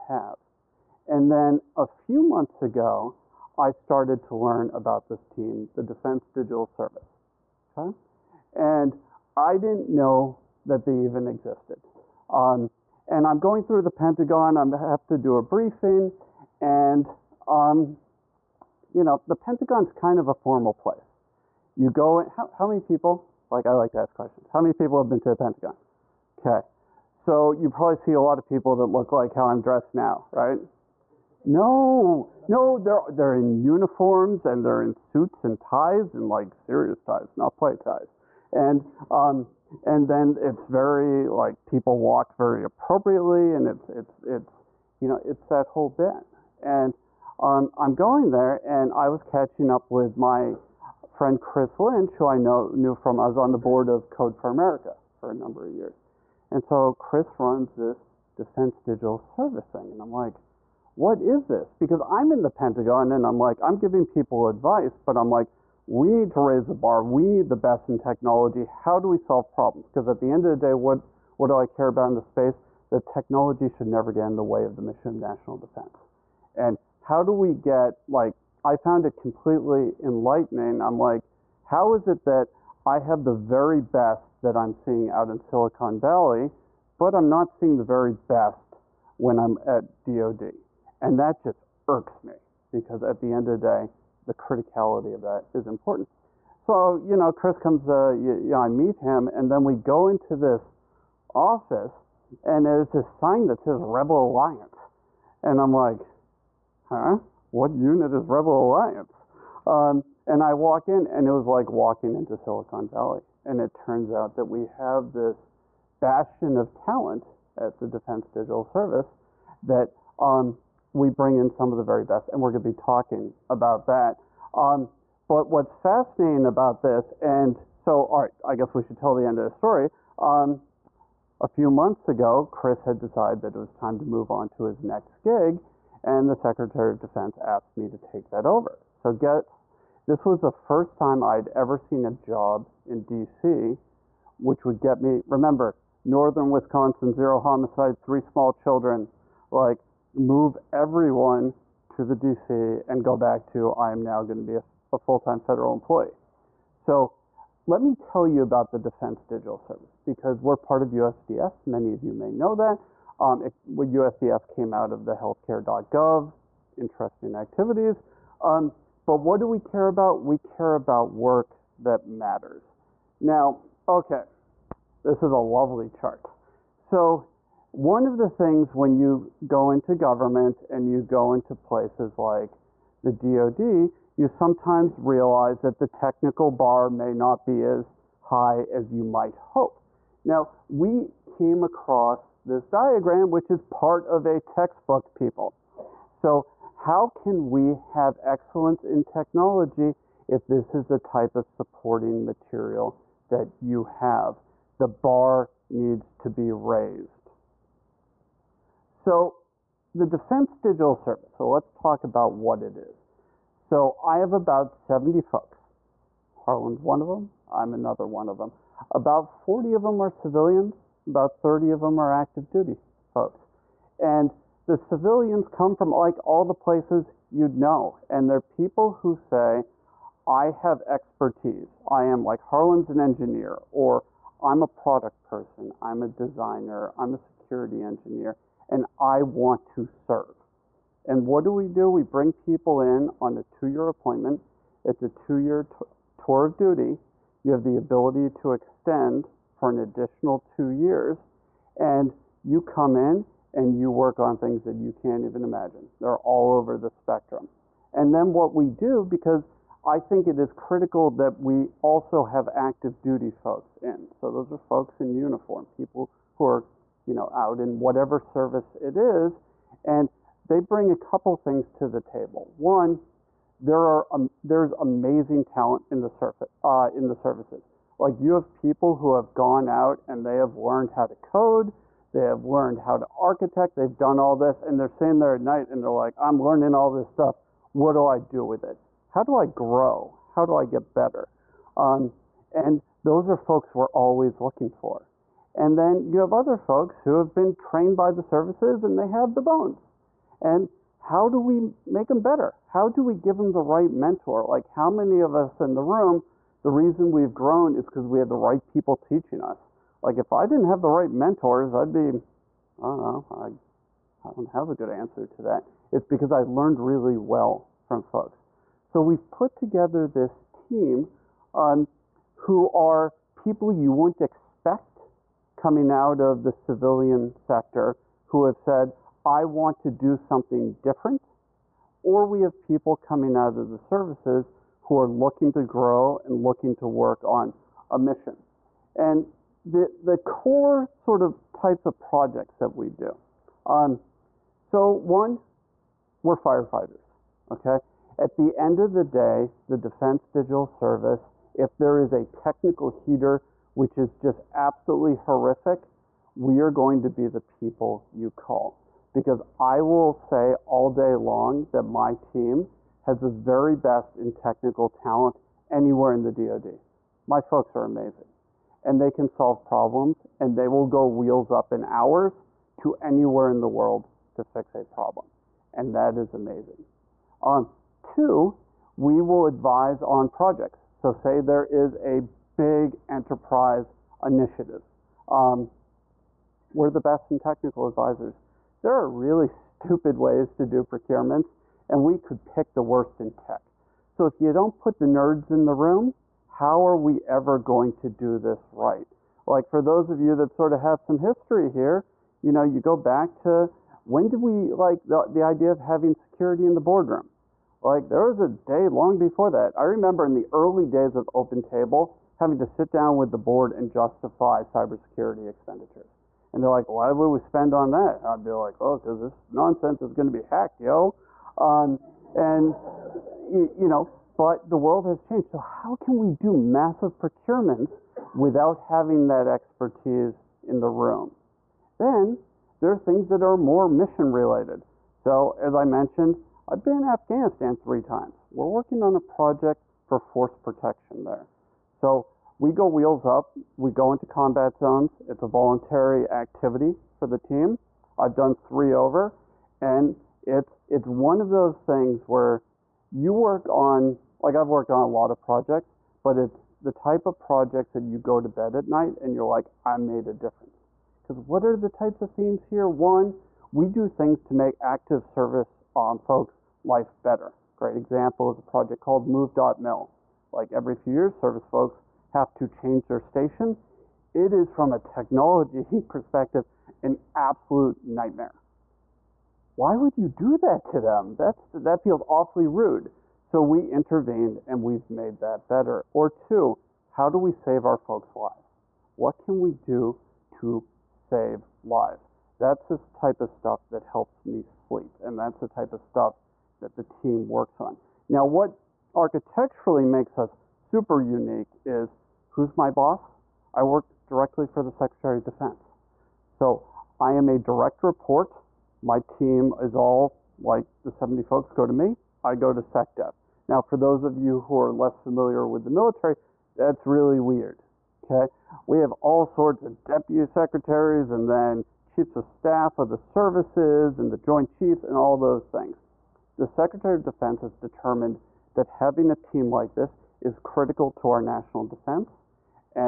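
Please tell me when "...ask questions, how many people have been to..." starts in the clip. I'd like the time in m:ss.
0:23.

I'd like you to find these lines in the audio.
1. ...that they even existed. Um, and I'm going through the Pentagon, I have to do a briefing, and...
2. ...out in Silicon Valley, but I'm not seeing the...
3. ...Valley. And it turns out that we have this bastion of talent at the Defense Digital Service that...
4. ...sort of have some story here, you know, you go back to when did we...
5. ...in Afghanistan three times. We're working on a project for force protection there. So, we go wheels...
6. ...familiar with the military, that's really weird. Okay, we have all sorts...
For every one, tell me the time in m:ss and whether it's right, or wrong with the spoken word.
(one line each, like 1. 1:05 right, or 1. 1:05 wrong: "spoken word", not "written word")
1. 0:10 right
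2. 1:25 right
3. 1:52 right
4. 6:40 wrong: "history", not "story"
5. 7:16 right
6. 8:35 right.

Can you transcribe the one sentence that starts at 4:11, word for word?
And you come in and you work on things that you can't even imagine.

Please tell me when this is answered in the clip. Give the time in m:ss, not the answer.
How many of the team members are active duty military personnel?
3:41.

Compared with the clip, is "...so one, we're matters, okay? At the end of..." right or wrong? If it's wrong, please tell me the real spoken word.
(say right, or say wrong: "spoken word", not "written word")
wrong: "firefighters", not "matters".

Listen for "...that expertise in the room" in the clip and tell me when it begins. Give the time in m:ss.
7:09.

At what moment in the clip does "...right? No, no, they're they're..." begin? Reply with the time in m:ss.
0:30.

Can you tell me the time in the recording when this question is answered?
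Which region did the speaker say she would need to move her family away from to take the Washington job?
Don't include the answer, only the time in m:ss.
2:26.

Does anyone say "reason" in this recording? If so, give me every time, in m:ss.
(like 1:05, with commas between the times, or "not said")
5:06.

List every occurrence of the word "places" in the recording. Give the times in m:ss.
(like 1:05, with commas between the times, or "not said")
0:20, 3:01, 3:46.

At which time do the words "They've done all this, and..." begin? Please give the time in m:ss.
4:43.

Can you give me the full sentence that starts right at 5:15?
It's because I learned really well from folks.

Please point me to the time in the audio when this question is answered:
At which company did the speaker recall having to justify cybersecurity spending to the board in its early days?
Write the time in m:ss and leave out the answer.
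6:51.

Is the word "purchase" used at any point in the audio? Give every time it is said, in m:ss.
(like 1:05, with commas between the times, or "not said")
not said.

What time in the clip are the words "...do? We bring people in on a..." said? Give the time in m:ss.
4:01.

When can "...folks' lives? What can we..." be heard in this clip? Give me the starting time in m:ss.
8:07.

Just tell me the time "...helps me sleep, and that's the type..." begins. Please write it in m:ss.
8:14.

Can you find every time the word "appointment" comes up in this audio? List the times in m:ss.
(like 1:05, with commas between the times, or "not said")
4:03.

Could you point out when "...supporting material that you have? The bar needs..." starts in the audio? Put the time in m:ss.
3:21.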